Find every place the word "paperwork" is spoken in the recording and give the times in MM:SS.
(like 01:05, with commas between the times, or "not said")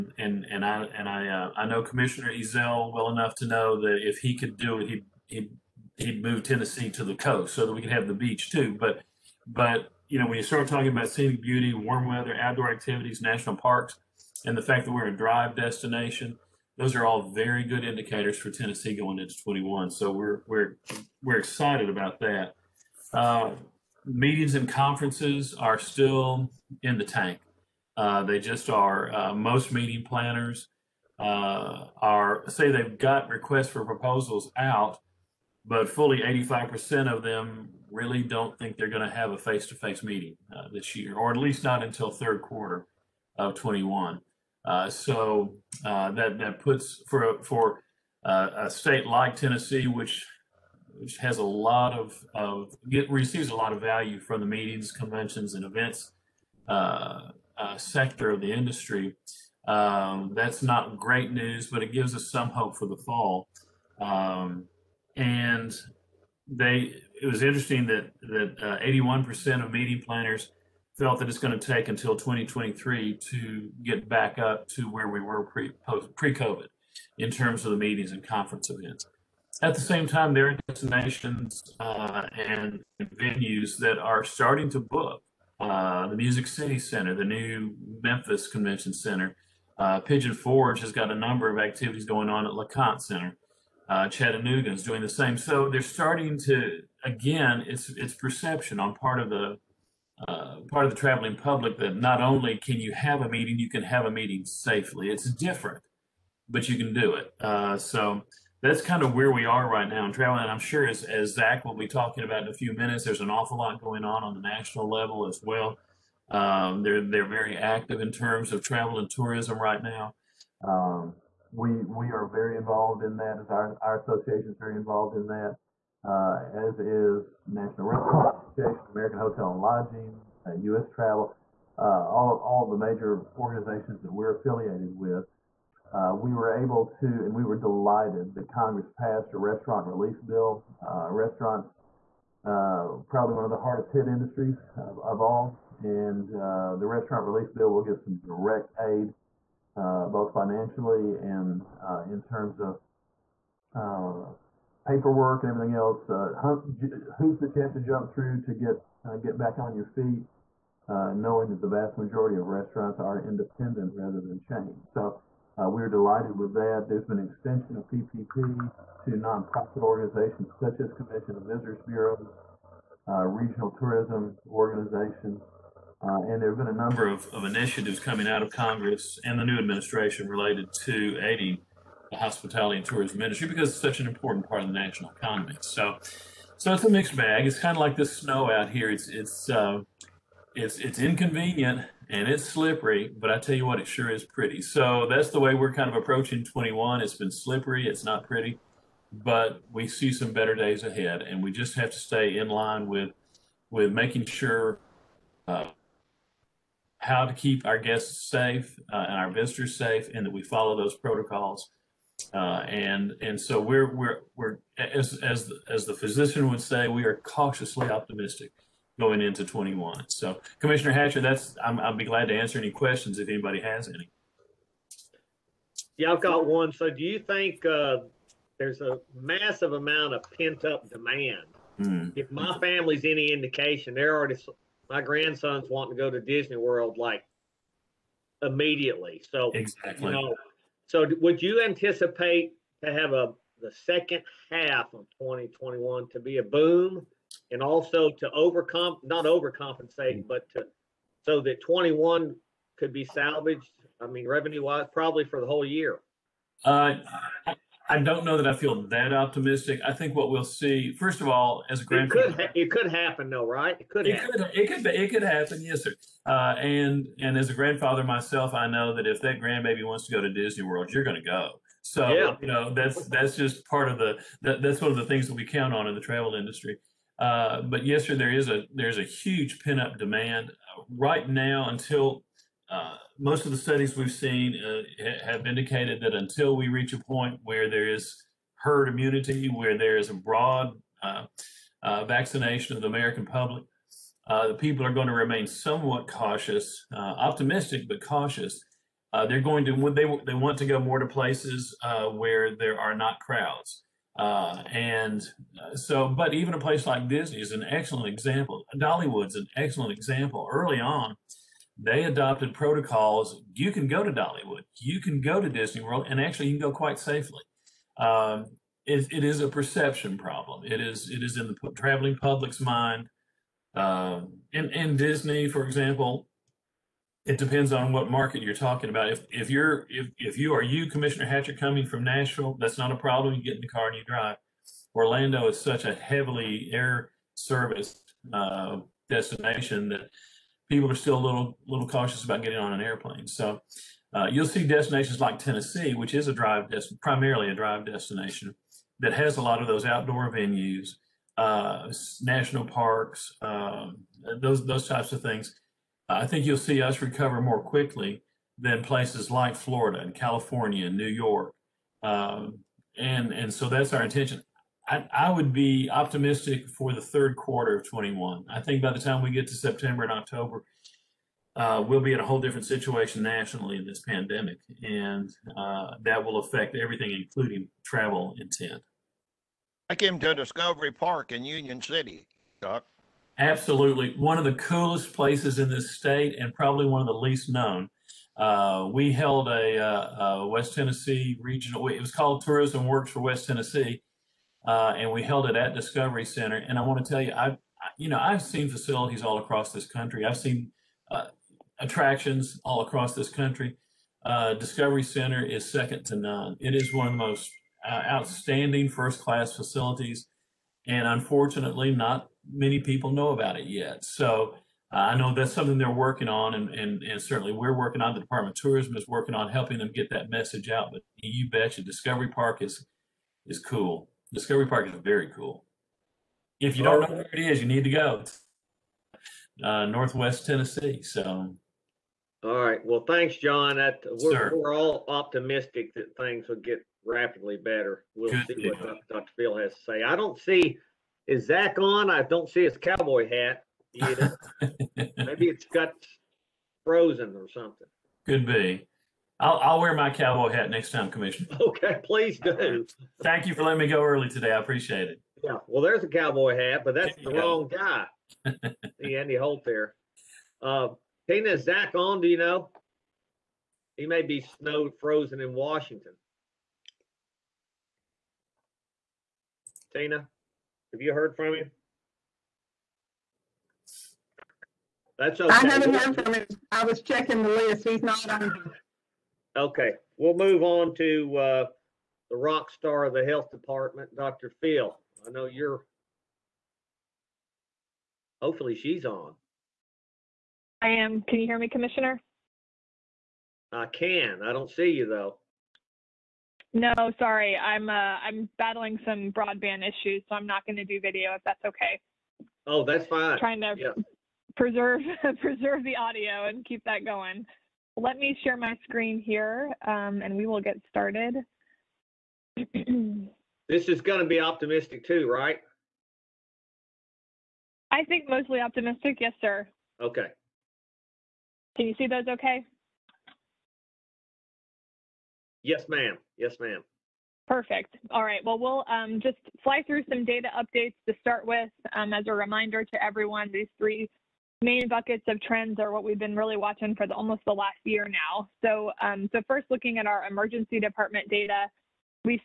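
02:34.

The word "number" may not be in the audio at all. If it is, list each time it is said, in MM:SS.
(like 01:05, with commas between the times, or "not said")
01:31, 02:56.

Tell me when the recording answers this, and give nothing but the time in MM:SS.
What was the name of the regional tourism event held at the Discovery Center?
06:32.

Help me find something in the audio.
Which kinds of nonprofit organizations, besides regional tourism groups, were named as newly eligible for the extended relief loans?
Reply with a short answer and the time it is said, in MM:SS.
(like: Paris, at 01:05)
Convention and Visitors Bureaus, at 02:50.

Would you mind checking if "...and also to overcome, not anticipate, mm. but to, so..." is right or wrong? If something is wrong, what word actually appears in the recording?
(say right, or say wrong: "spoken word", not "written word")
wrong: "overcompensate", not "anticipate".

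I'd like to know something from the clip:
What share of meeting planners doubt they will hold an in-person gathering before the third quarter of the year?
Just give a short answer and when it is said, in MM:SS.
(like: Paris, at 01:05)
85%, at 00:36.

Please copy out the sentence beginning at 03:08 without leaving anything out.
It's it's uh, it's it's inconvenient, and it's slippery, but I tell you what, it sure is pretty.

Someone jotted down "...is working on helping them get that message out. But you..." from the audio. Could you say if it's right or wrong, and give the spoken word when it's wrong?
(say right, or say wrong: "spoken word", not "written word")
right.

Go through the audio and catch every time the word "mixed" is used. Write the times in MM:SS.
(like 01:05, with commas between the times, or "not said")
03:06.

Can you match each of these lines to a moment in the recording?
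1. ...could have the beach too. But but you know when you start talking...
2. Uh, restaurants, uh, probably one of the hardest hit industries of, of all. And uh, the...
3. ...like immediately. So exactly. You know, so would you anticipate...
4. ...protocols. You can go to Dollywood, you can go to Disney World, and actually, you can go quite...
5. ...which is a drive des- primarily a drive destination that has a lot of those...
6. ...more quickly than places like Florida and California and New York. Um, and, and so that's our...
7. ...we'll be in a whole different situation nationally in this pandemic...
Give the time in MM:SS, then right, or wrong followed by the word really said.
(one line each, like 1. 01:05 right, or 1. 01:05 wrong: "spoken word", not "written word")
1. 00:07 right
2. 02:20 right
3. 03:56 right
4. 05:12 right
5. 05:45 right
6. 05:57 right
7. 06:11 right.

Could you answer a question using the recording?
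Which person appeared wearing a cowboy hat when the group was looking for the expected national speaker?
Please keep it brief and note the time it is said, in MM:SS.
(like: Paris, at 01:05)
Andy Holt, at 07:39.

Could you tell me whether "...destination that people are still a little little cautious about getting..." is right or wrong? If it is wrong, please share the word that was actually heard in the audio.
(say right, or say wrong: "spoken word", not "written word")
right.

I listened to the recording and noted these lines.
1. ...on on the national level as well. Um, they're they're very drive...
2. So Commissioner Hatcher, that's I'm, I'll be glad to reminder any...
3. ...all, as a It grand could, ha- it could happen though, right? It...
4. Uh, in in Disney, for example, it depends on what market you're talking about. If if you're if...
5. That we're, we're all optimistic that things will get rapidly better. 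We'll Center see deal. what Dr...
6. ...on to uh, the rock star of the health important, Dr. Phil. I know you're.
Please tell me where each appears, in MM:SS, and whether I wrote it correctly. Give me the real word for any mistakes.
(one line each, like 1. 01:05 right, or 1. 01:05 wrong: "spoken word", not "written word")
1. 01:54 wrong: "active", not "drive"
2. 03:40 wrong: "answer", not "reminder"
3. 04:21 right
4. 05:23 right
5. 07:13 wrong: "Good", not "Center"
6. 08:00 wrong: "department", not "important".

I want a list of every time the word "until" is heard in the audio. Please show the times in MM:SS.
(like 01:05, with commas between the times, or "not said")
00:41, 01:11, 04:41, 04:46.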